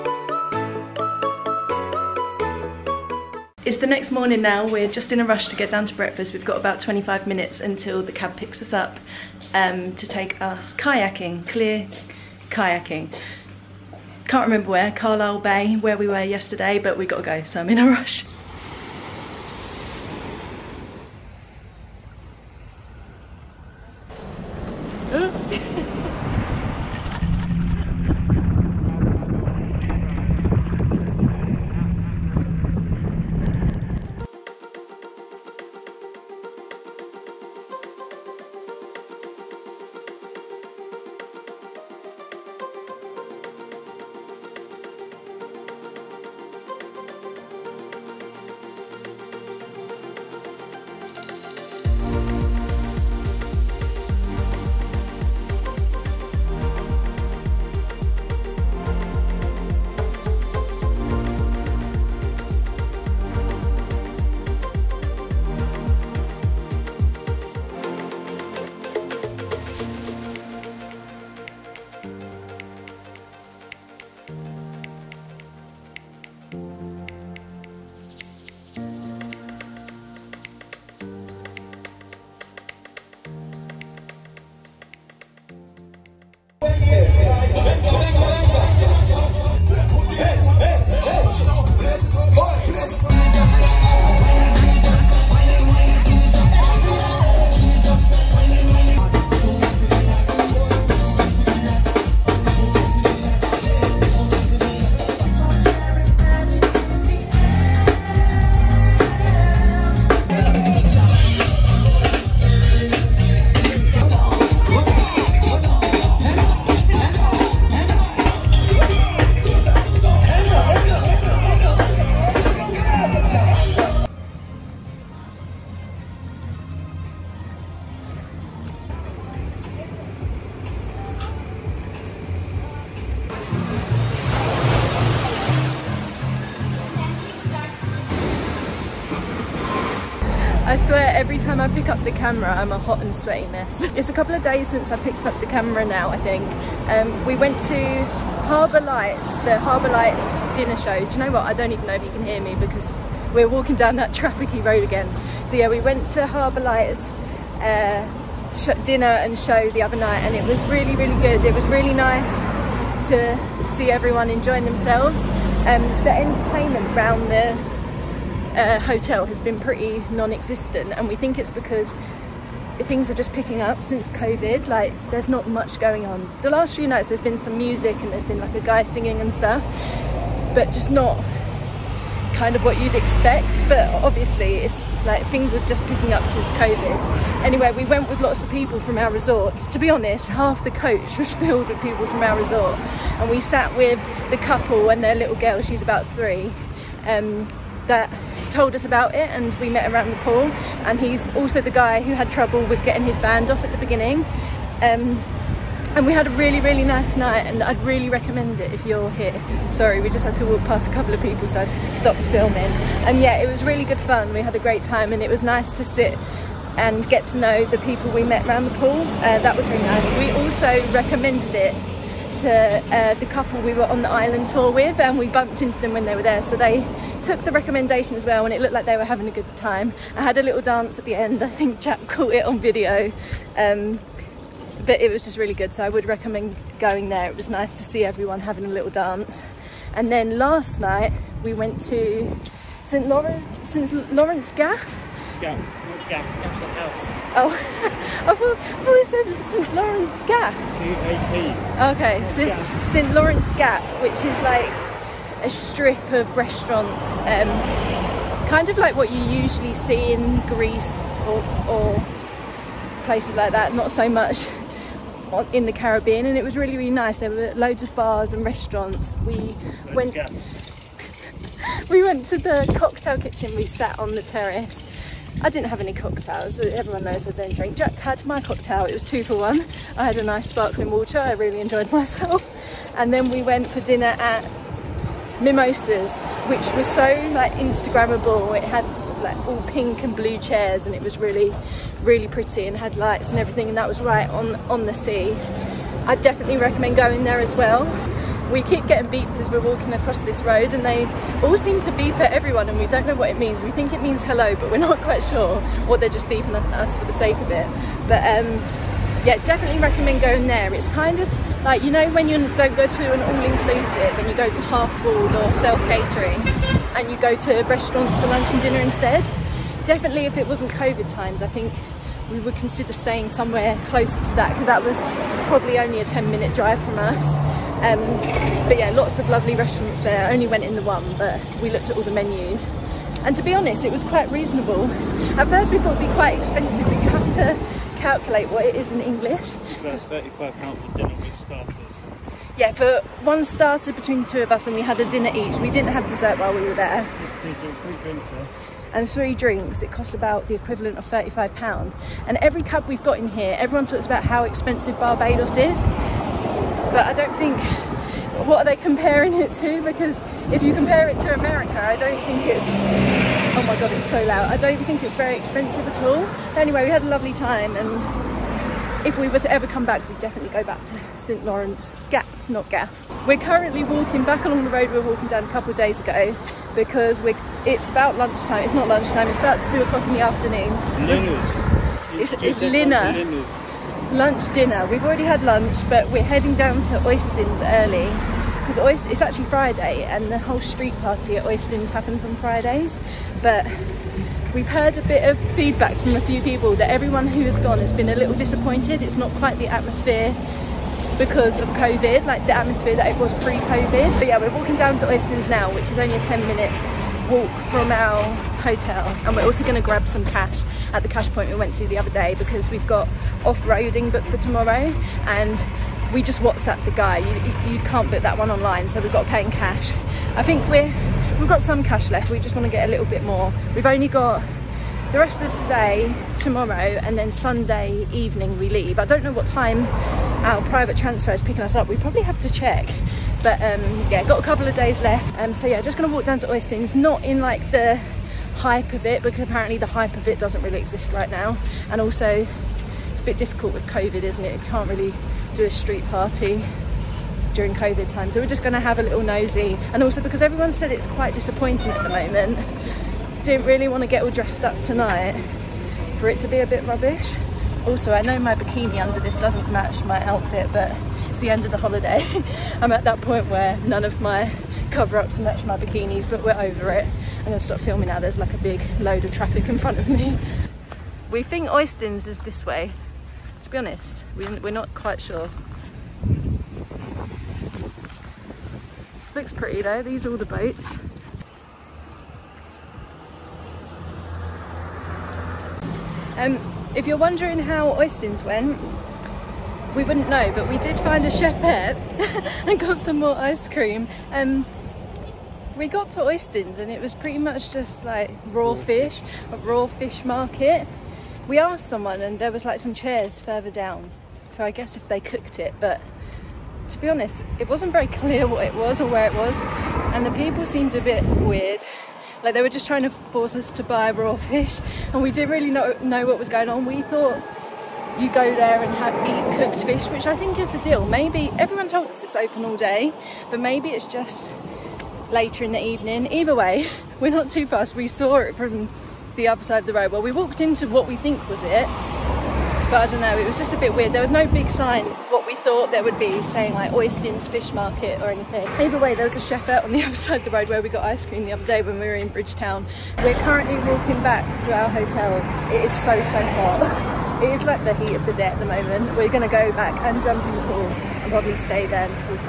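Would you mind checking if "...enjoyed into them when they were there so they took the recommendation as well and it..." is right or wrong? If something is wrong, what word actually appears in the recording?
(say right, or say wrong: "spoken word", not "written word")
wrong: "bumped", not "enjoyed".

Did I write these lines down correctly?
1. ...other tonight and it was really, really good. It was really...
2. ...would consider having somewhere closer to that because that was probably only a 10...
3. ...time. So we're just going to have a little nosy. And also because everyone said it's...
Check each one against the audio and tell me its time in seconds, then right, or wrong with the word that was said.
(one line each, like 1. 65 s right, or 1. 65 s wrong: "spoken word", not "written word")
1. 159 s wrong: "night", not "tonight"
2. 322 s wrong: "staying", not "having"
3. 448 s right.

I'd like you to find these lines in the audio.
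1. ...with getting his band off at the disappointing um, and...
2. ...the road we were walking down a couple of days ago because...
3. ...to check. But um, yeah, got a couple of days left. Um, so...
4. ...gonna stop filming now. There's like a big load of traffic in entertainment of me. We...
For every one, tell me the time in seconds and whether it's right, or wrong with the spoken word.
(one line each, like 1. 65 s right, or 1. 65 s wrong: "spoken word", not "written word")
1. 202 s wrong: "beginning", not "disappointing"
2. 374 s right
3. 432 s right
4. 467 s wrong: "front", not "entertainment".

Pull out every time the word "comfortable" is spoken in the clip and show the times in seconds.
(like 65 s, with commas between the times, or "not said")
not said.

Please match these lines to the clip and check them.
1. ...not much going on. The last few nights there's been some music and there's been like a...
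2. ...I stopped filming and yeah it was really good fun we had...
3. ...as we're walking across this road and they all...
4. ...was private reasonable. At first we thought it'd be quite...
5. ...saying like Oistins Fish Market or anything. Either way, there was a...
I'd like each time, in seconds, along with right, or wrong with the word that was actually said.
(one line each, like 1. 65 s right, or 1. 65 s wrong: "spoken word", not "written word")
1. 175 s right
2. 211 s right
3. 299 s right
4. 333 s wrong: "quite", not "private"
5. 536 s right.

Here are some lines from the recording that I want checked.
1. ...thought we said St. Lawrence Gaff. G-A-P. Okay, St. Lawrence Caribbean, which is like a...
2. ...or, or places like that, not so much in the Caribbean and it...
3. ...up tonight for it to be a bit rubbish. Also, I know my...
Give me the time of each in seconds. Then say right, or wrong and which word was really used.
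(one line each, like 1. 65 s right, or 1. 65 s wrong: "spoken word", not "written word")
1. 248 s wrong: "Gap", not "Caribbean"
2. 261 s right
3. 454 s right.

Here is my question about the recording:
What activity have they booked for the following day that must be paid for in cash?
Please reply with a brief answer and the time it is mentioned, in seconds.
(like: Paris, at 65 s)
off-roading, at 413 s.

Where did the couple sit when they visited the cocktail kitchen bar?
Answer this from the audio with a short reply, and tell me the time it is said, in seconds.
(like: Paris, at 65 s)
the terrace, at 274 s.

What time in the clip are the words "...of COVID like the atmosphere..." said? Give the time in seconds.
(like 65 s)
401 s.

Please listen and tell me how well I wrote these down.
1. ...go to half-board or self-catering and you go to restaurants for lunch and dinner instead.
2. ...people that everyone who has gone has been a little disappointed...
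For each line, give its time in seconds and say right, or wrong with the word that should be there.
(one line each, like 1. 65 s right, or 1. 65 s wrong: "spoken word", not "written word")
1. 314 s right
2. 396 s right.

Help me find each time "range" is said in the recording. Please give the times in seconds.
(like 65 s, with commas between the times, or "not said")
not said.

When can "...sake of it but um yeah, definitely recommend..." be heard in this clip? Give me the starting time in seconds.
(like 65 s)
307 s.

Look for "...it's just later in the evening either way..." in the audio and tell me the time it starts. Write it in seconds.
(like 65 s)
523 s.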